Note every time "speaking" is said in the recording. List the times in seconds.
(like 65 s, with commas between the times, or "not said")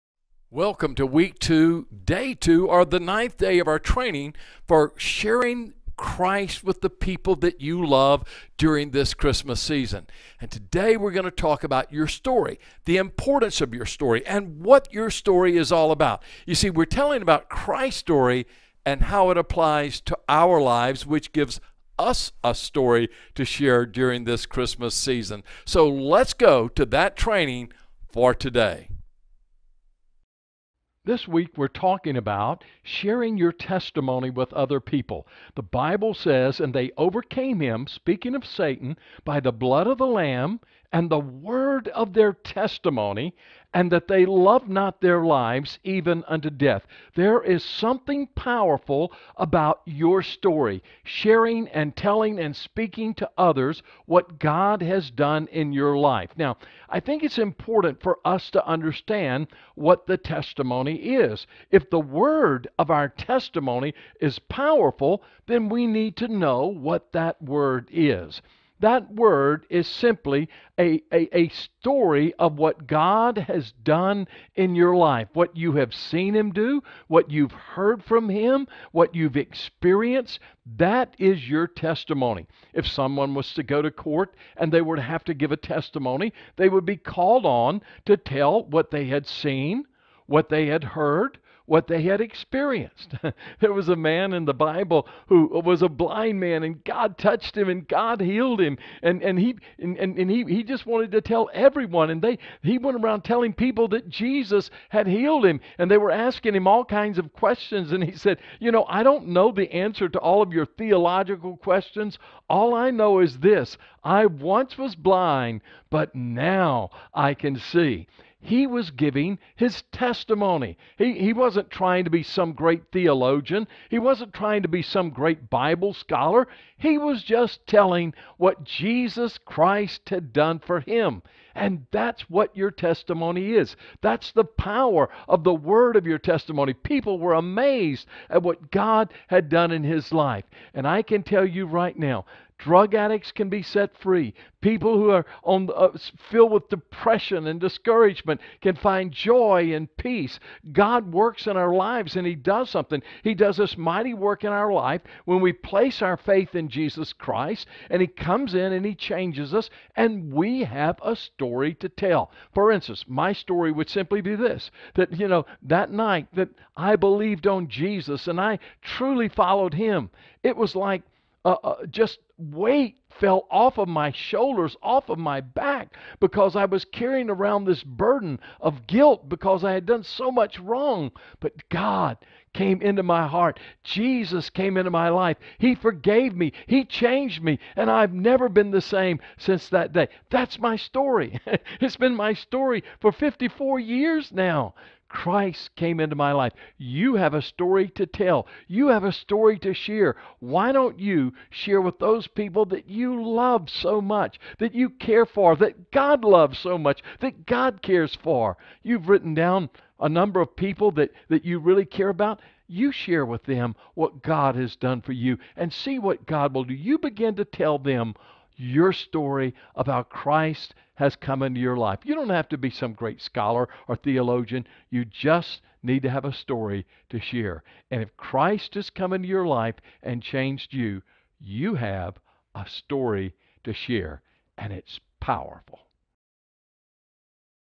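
37 s, 52 s.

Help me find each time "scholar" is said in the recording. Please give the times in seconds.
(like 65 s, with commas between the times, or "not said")
125 s, 223 s.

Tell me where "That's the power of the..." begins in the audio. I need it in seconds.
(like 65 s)
134 s.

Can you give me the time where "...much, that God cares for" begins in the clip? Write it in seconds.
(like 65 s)
206 s.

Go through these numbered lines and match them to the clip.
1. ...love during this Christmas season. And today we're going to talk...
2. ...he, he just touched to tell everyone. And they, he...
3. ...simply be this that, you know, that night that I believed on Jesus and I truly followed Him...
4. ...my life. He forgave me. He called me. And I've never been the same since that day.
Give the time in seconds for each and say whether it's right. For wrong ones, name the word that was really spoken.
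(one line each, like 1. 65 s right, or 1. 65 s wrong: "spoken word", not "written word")
1. 7 s right
2. 100 s wrong: "wanted", not "touched"
3. 163 s right
4. 184 s wrong: "changed", not "called".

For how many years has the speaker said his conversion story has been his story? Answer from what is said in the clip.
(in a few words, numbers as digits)
54.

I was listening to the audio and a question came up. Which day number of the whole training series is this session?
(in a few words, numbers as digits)
9th.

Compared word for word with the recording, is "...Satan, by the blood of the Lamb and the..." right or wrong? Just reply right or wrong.
right.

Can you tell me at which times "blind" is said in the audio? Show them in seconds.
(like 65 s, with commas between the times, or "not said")
95 s, 114 s.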